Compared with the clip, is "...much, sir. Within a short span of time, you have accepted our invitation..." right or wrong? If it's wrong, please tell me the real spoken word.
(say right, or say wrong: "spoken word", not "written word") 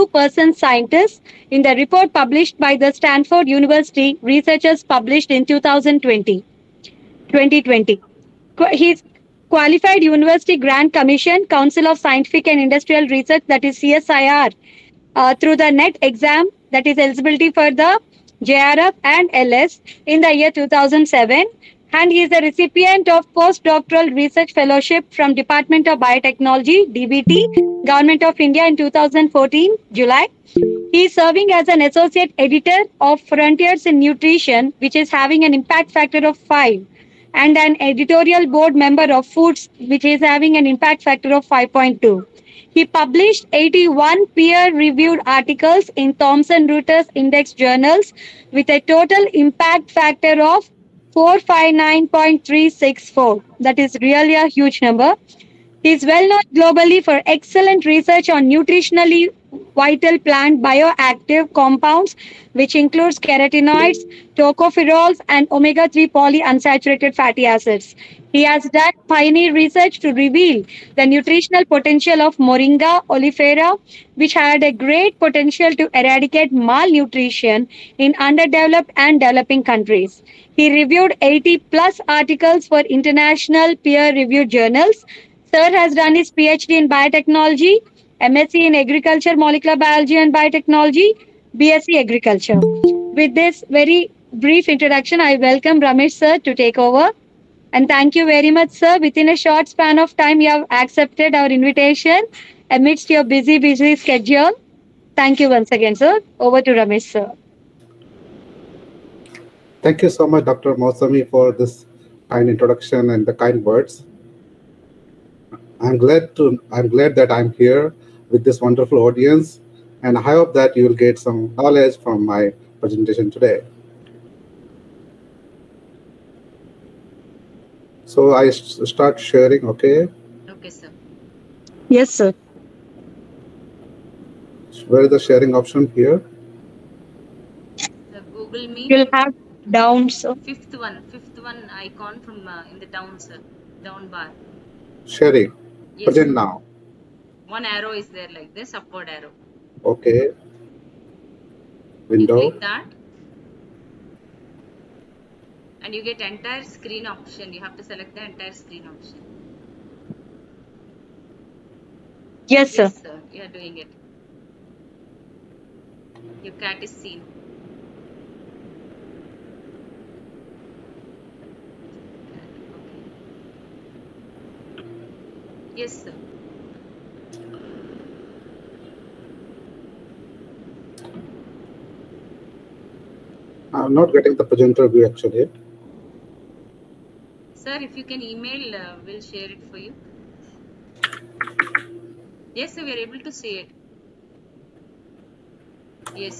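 right.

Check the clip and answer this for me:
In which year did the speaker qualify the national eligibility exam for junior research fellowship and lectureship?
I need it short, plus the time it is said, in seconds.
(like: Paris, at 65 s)
2007, at 20 s.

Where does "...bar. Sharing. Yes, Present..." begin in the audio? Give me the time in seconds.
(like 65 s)
144 s.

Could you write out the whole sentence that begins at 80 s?
He reviewed 80 plus articles for international peer reviewed journals.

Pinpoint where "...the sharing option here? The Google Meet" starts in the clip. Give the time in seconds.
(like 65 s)
135 s.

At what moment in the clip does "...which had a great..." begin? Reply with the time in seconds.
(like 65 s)
74 s.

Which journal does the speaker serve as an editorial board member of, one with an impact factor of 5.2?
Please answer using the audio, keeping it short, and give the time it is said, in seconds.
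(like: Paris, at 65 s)
Foods, at 39 s.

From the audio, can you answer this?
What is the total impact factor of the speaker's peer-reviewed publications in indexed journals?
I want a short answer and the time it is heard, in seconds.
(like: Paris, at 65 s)
459.364, at 51 s.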